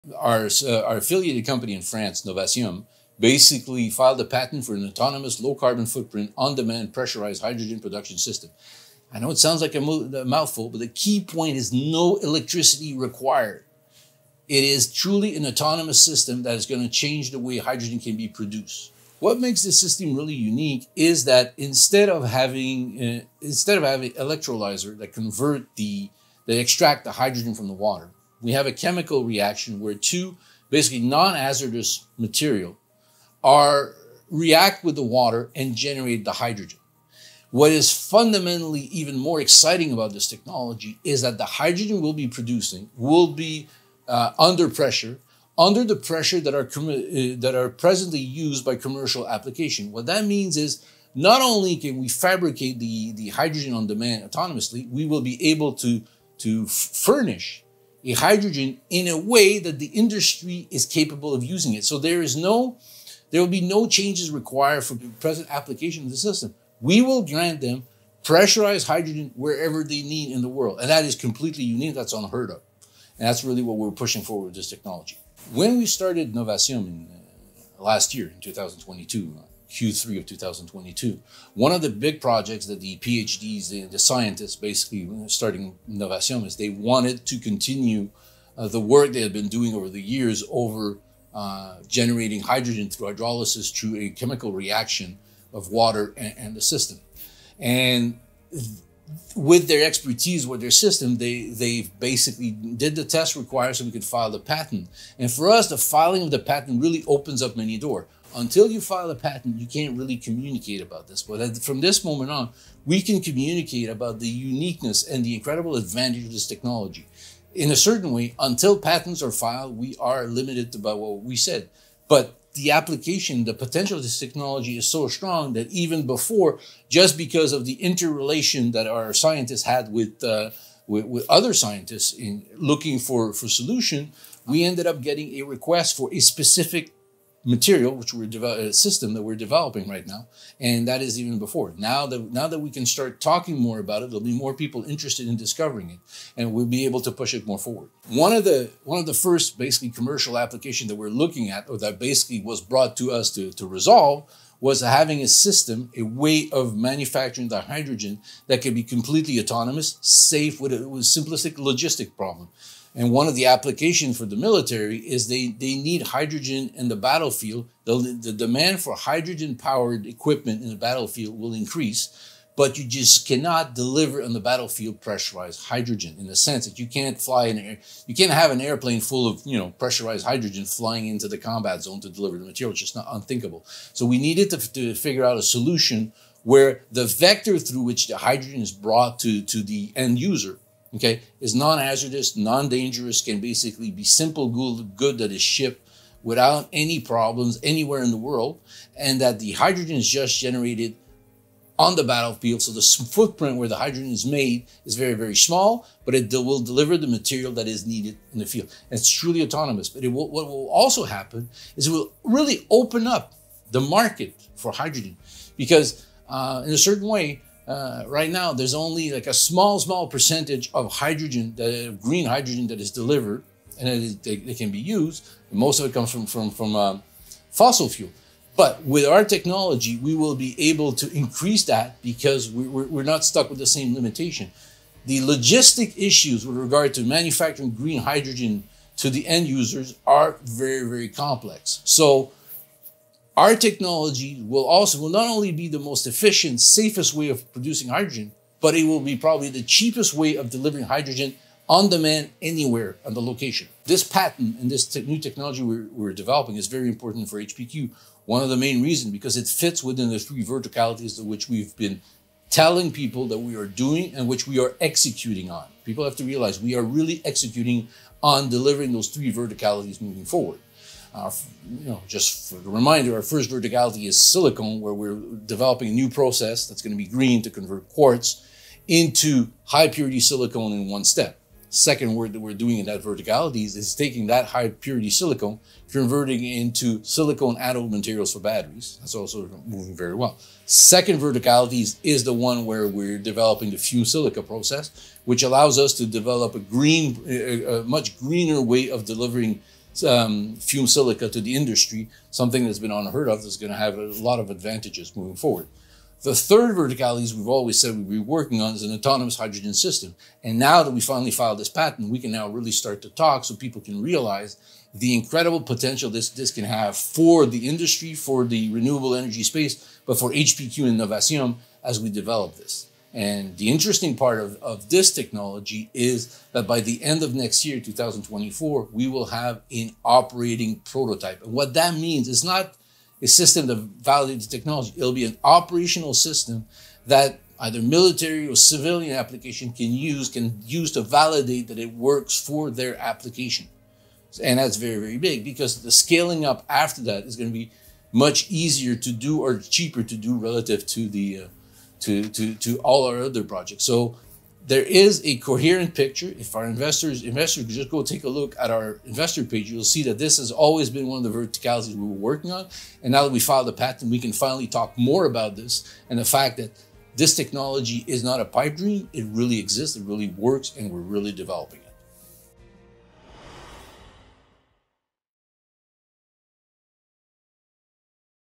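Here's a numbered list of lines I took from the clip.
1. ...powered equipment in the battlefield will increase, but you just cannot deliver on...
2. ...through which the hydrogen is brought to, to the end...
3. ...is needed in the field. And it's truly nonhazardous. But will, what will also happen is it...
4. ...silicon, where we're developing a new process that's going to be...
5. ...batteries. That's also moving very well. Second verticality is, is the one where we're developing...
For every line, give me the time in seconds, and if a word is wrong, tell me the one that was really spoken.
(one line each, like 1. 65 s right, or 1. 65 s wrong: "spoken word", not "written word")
1. 169 s right
2. 187 s right
3. 207 s wrong: "autonomous", not "nonhazardous"
4. 274 s right
5. 288 s right.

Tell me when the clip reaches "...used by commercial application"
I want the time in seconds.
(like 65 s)
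48 s.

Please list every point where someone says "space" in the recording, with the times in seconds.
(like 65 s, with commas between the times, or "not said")
319 s.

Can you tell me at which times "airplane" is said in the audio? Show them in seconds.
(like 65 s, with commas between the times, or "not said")
178 s.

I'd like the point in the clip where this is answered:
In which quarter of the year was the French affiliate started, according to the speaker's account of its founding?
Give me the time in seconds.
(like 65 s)
79 s.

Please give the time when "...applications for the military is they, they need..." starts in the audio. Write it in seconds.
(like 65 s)
163 s.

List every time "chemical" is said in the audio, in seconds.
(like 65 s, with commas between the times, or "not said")
28 s, 94 s.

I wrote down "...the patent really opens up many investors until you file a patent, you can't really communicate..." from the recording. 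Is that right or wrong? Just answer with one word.
wrong.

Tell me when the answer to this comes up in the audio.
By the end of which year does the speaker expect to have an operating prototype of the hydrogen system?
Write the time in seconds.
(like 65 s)
327 s.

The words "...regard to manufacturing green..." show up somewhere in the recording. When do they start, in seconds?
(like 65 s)
236 s.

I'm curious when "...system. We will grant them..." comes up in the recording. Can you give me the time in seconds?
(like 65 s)
66 s.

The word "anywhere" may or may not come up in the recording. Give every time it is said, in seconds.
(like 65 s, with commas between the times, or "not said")
197 s, 252 s.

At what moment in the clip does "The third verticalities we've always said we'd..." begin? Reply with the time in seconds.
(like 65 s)
306 s.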